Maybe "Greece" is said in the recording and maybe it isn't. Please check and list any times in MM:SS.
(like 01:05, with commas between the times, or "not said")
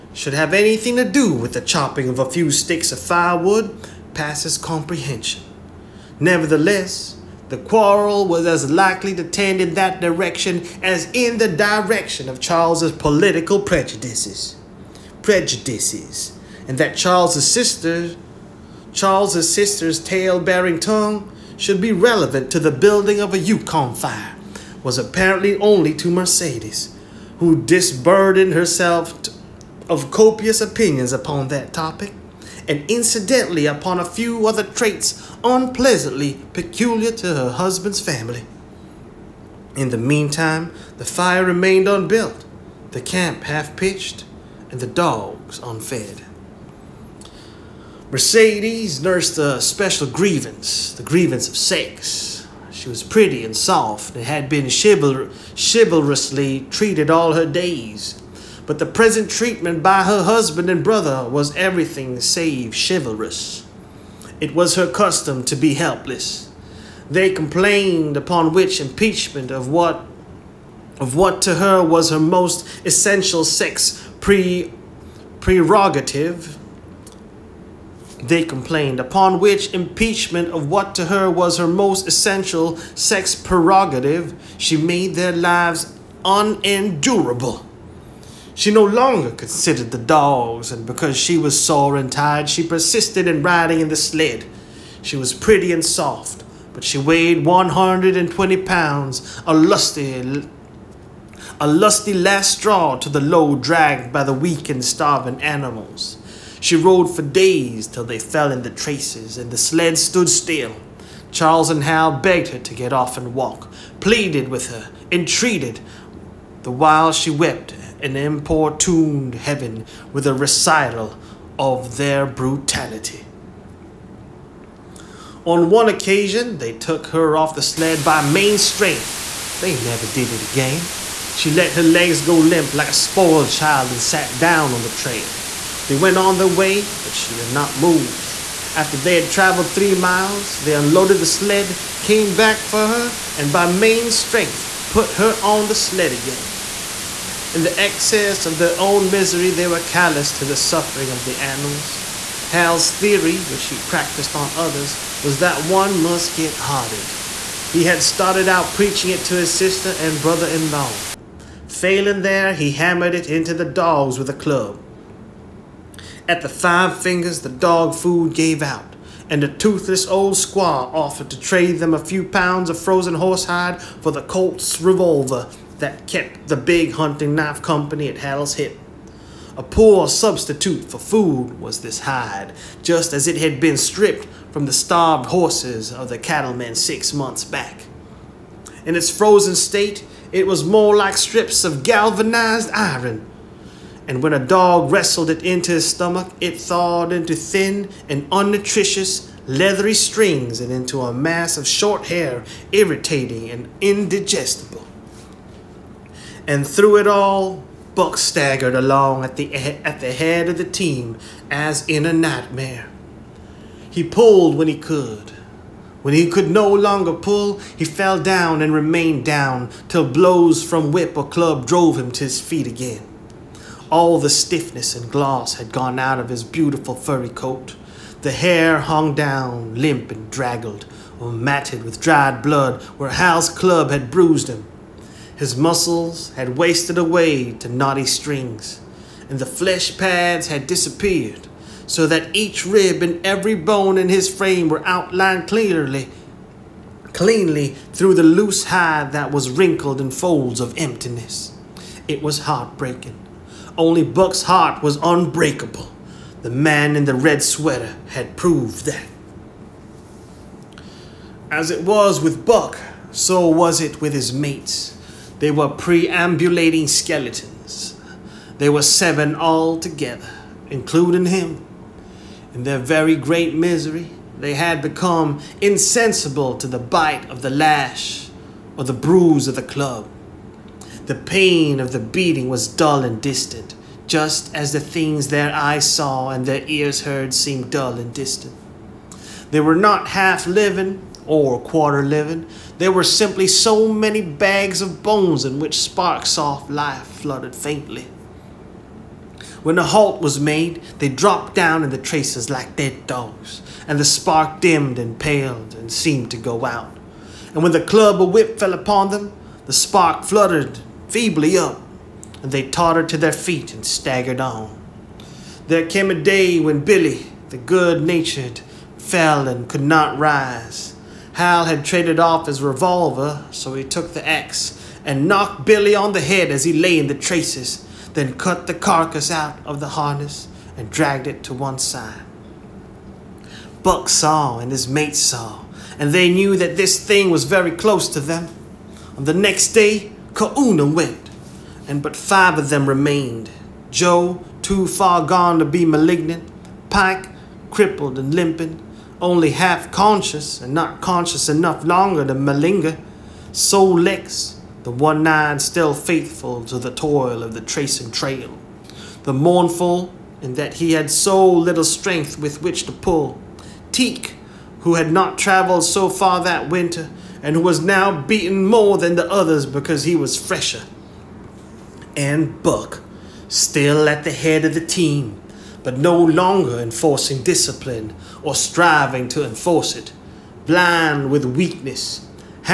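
not said.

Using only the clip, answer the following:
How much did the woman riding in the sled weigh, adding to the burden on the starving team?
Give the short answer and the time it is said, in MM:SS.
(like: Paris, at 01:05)
120 pounds, at 01:37.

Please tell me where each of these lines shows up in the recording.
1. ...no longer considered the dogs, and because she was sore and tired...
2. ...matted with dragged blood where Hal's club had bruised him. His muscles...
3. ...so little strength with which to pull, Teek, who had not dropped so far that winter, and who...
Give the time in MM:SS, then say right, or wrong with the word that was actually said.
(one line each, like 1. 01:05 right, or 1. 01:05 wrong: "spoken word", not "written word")
1. 01:28 right
2. 03:51 wrong: "dried", not "dragged"
3. 06:01 wrong: "traveled", not "dropped".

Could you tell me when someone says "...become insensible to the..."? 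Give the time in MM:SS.
04:34.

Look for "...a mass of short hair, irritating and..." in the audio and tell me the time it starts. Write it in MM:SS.
03:21.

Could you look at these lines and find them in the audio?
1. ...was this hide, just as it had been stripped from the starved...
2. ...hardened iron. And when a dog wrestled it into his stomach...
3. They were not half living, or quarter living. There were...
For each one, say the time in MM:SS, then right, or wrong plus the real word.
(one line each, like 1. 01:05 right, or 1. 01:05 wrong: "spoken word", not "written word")
1. 03:01 right
2. 03:11 wrong: "galvanized", not "hardened"
3. 04:49 right.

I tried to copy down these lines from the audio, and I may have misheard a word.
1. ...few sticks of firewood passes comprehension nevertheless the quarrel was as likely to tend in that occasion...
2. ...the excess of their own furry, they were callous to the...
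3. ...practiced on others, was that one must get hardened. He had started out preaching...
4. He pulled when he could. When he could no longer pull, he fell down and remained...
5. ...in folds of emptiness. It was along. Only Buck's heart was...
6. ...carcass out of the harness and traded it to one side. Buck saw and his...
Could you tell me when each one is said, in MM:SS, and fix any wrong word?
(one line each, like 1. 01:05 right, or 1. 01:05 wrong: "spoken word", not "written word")
1. 00:02 wrong: "direction", not "occasion"
2. 02:27 wrong: "misery", not "furry"
3. 02:33 right
4. 03:33 right
5. 04:09 wrong: "heartbreaking", not "along"
6. 05:28 wrong: "dragged", not "traded".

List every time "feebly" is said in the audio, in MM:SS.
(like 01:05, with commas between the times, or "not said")
05:11.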